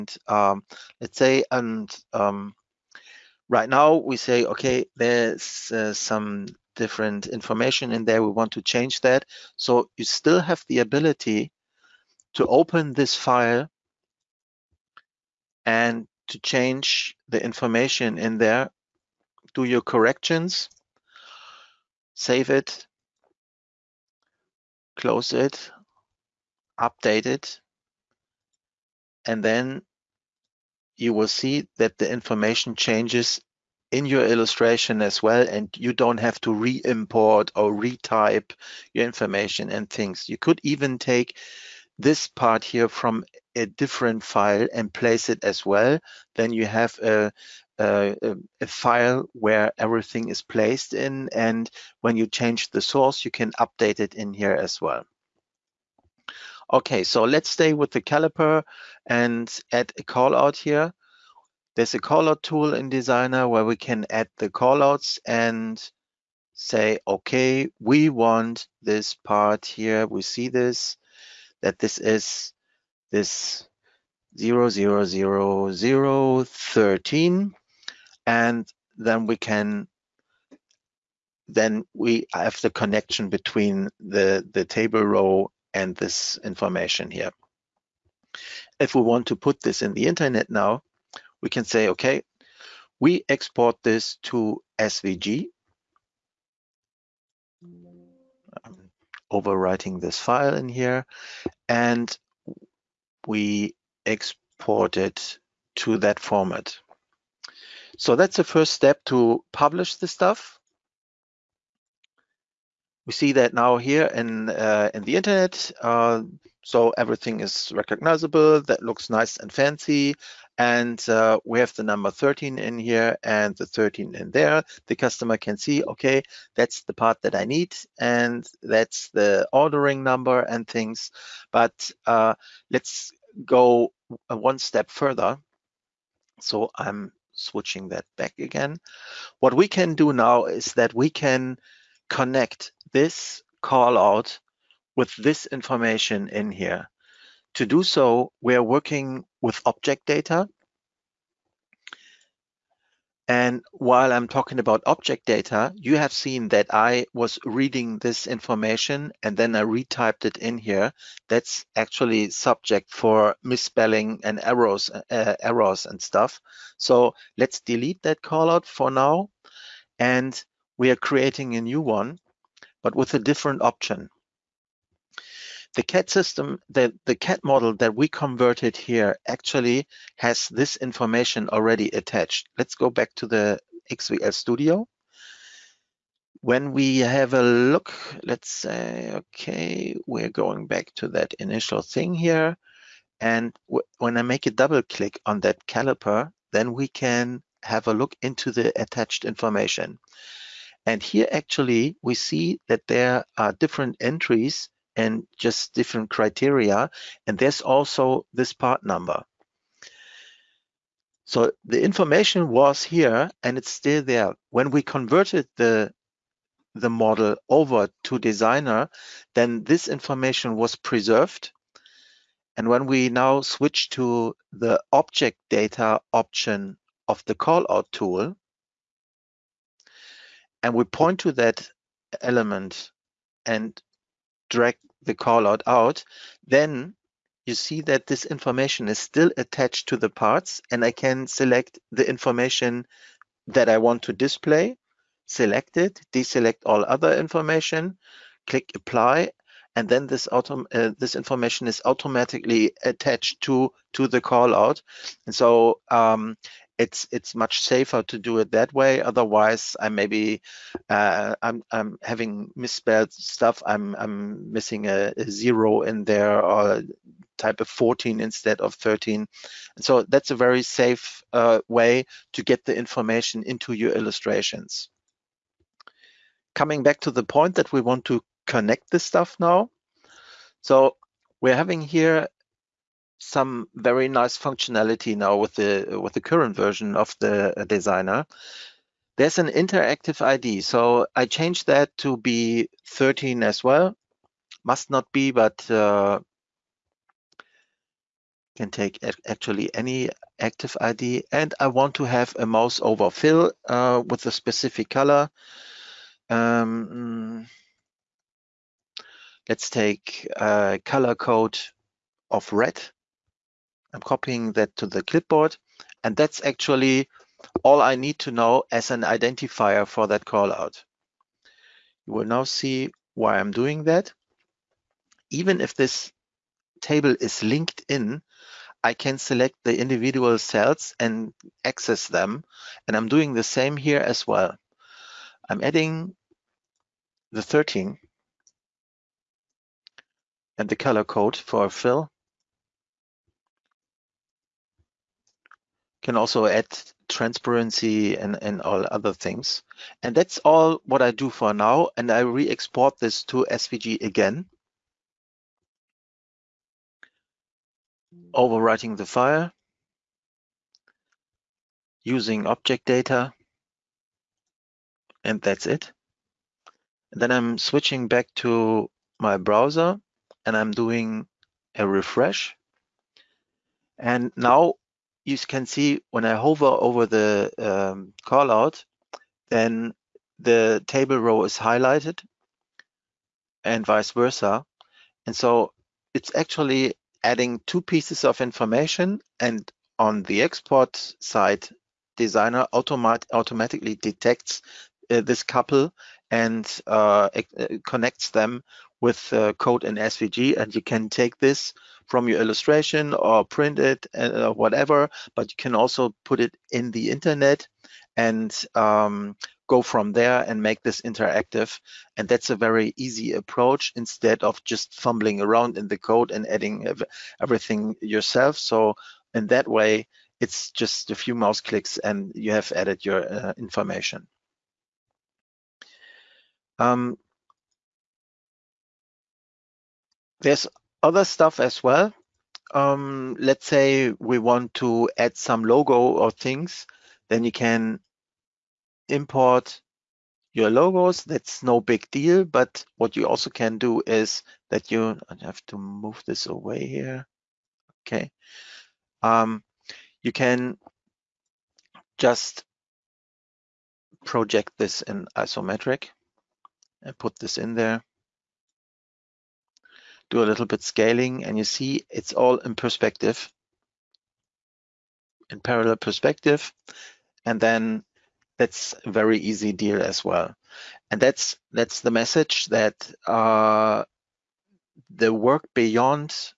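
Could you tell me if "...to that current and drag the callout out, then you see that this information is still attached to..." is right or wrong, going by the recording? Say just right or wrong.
wrong.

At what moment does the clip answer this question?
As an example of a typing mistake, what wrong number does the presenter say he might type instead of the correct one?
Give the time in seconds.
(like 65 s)
267 s.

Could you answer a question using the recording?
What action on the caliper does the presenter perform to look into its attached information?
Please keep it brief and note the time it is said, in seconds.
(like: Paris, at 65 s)
double click, at 194 s.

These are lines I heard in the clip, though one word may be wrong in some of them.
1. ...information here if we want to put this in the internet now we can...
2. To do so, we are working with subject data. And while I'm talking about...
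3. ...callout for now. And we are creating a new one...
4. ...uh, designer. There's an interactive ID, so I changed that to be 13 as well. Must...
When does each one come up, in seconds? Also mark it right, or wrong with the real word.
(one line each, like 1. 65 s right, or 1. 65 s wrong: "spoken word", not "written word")
1. 86 s right
2. 147 s wrong: "object", not "subject"
3. 168 s right
4. 287 s right.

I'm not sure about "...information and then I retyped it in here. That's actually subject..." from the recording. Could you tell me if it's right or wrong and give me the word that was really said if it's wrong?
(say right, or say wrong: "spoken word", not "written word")
right.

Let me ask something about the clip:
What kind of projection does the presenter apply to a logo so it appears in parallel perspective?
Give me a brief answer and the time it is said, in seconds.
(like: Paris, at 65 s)
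isometric, at 455 s.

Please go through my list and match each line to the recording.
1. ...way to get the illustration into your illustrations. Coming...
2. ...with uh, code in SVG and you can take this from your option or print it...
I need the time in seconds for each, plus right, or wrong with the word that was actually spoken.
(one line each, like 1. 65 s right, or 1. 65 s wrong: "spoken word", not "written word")
1. 271 s wrong: "information", not "illustration"
2. 399 s wrong: "illustration", not "option".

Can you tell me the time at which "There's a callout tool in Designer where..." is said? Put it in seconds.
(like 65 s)
61 s.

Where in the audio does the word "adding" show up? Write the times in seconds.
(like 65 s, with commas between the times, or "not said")
335 s, 387 s, 416 s.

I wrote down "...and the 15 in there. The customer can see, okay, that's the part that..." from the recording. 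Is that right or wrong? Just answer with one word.
wrong.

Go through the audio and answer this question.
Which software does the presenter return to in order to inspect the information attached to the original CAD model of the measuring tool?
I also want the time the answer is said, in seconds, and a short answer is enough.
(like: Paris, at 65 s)
XVL Studio, at 183 s.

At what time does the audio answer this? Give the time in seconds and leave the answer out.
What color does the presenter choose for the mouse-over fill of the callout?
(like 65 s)
312 s.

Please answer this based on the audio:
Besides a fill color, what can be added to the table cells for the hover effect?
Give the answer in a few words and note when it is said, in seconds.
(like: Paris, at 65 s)
transparency, at 347 s.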